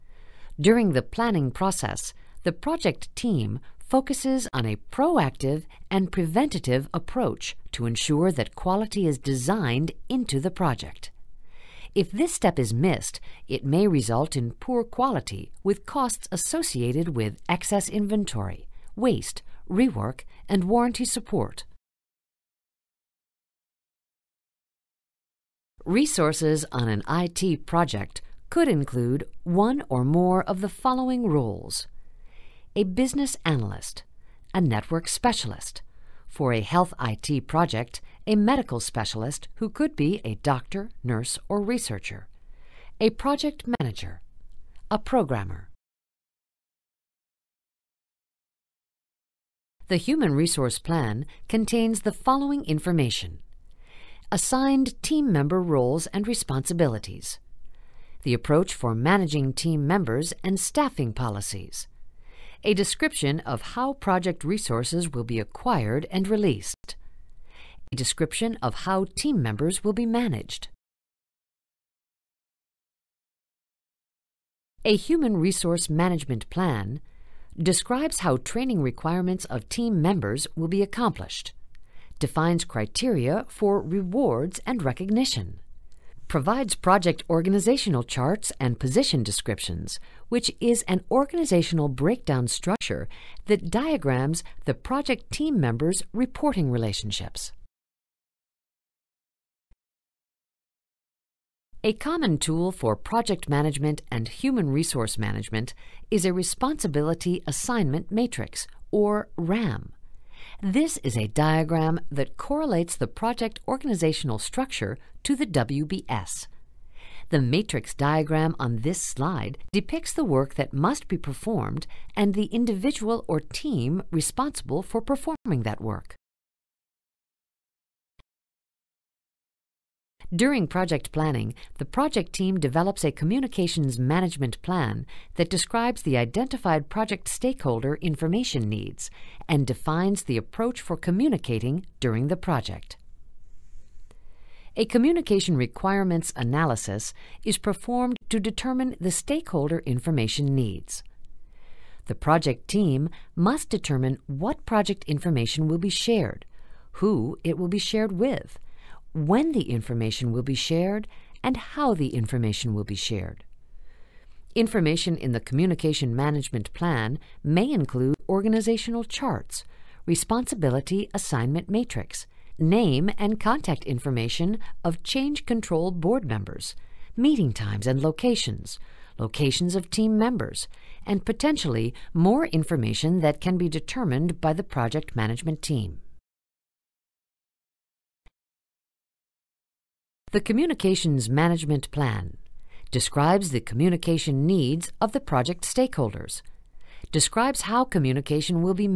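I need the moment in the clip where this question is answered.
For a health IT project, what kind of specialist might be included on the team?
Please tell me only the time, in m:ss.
0:38.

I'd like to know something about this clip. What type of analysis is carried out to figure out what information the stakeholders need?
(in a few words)
communication requirements analysis.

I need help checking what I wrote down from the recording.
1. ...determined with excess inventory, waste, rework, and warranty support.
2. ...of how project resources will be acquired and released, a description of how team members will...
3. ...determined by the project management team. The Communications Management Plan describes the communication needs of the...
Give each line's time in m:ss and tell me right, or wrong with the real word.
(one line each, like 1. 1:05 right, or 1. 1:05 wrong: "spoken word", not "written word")
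1. 0:16 wrong: "associated", not "determined"
2. 1:03 right
3. 3:03 right.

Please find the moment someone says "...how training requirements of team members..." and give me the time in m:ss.
1:18.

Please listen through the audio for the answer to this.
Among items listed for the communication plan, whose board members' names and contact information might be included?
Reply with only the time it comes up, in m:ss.
2:55.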